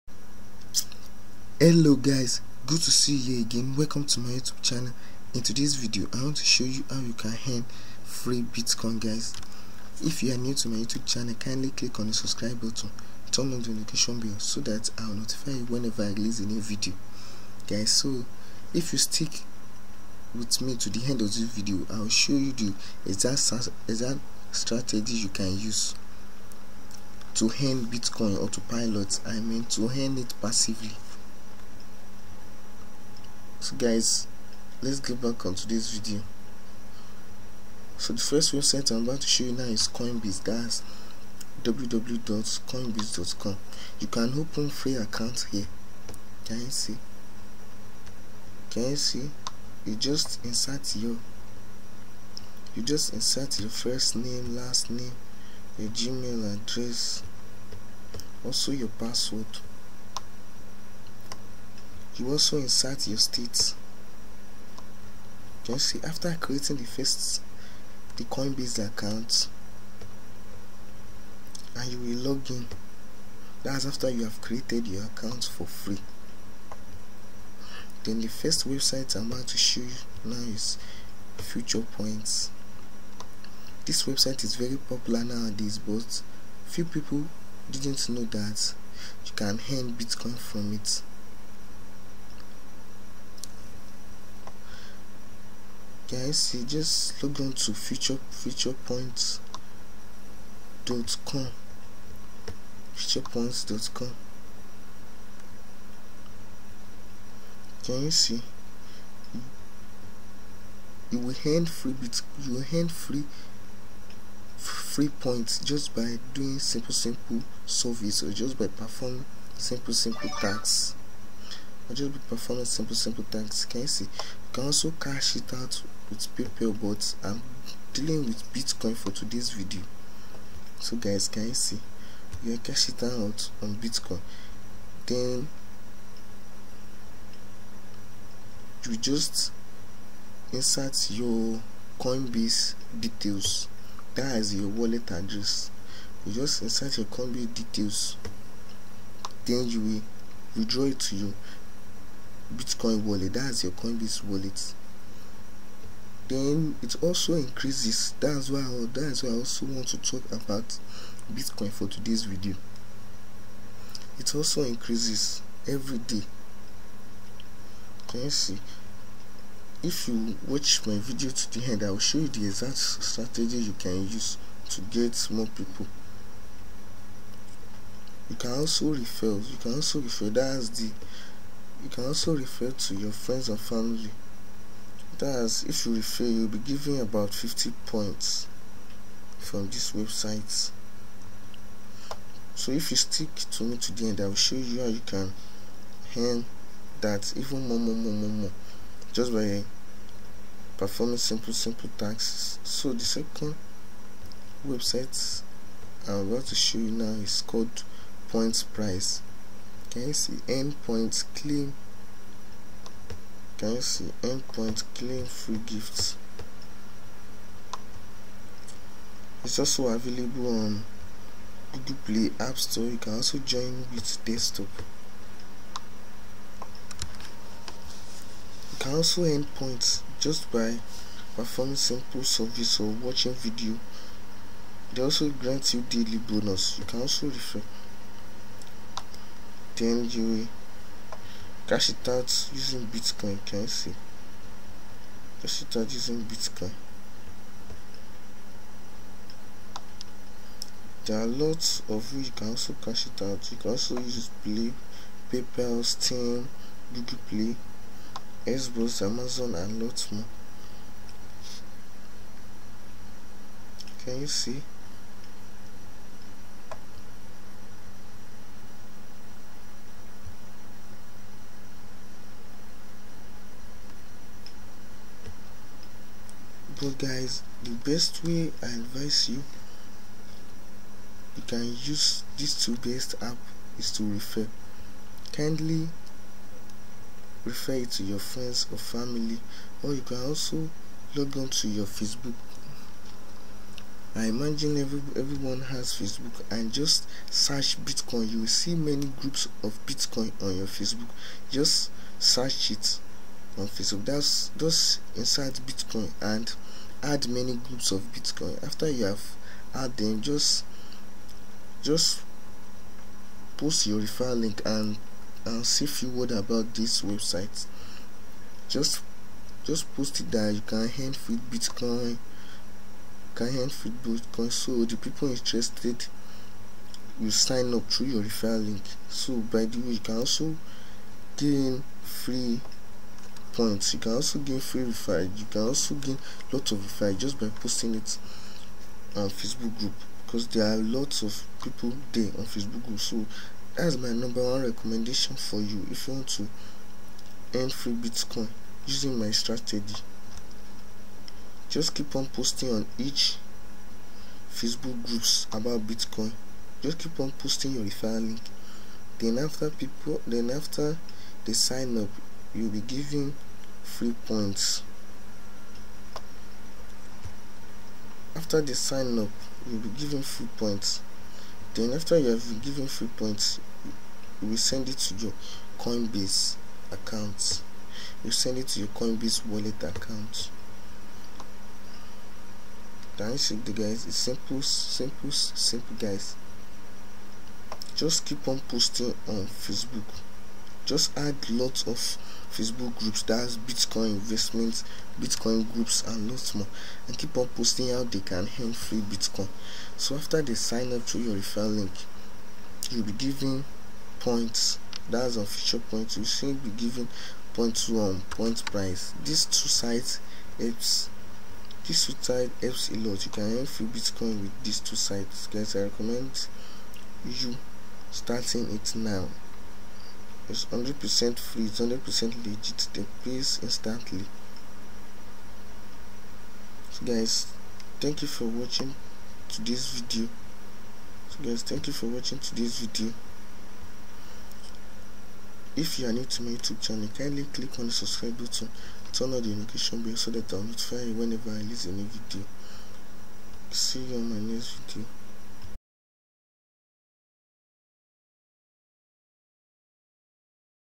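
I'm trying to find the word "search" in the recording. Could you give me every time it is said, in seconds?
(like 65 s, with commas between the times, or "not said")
297 s, 302 s.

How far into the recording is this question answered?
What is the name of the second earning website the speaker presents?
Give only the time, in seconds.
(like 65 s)
208 s.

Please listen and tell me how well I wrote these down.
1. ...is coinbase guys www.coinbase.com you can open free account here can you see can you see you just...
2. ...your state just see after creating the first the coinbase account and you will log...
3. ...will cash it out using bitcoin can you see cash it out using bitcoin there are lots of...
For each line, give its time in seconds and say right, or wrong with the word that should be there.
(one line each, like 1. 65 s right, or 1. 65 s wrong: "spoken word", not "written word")
1. 39 s right
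2. 63 s right
3. 240 s right.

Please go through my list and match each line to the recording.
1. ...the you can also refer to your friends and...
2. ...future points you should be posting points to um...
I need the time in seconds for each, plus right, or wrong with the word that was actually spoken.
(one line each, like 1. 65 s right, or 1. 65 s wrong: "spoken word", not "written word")
1. 180 s right
2. 405 s wrong: "giving", not "posting".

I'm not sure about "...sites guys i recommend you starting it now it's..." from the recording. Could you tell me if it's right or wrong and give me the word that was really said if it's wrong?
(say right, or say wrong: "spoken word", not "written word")
right.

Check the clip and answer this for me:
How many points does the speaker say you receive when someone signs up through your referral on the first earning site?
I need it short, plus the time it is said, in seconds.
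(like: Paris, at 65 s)
50, at 187 s.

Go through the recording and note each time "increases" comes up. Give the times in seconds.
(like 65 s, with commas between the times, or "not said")
157 s, 164 s.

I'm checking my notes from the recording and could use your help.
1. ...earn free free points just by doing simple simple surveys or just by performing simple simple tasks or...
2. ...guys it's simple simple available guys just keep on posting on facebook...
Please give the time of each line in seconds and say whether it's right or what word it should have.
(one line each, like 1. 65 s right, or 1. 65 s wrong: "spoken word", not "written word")
1. 112 s right
2. 383 s wrong: "simple", not "available".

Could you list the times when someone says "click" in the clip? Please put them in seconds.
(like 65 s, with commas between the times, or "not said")
11 s, 437 s.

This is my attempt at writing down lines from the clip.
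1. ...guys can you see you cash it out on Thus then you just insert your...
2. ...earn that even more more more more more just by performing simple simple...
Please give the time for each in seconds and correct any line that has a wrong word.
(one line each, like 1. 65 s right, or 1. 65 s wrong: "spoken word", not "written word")
1. 130 s wrong: "Bitcoin", not "Thus"
2. 196 s right.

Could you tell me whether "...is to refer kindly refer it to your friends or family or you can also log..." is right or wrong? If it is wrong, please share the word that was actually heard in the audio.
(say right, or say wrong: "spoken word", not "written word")
right.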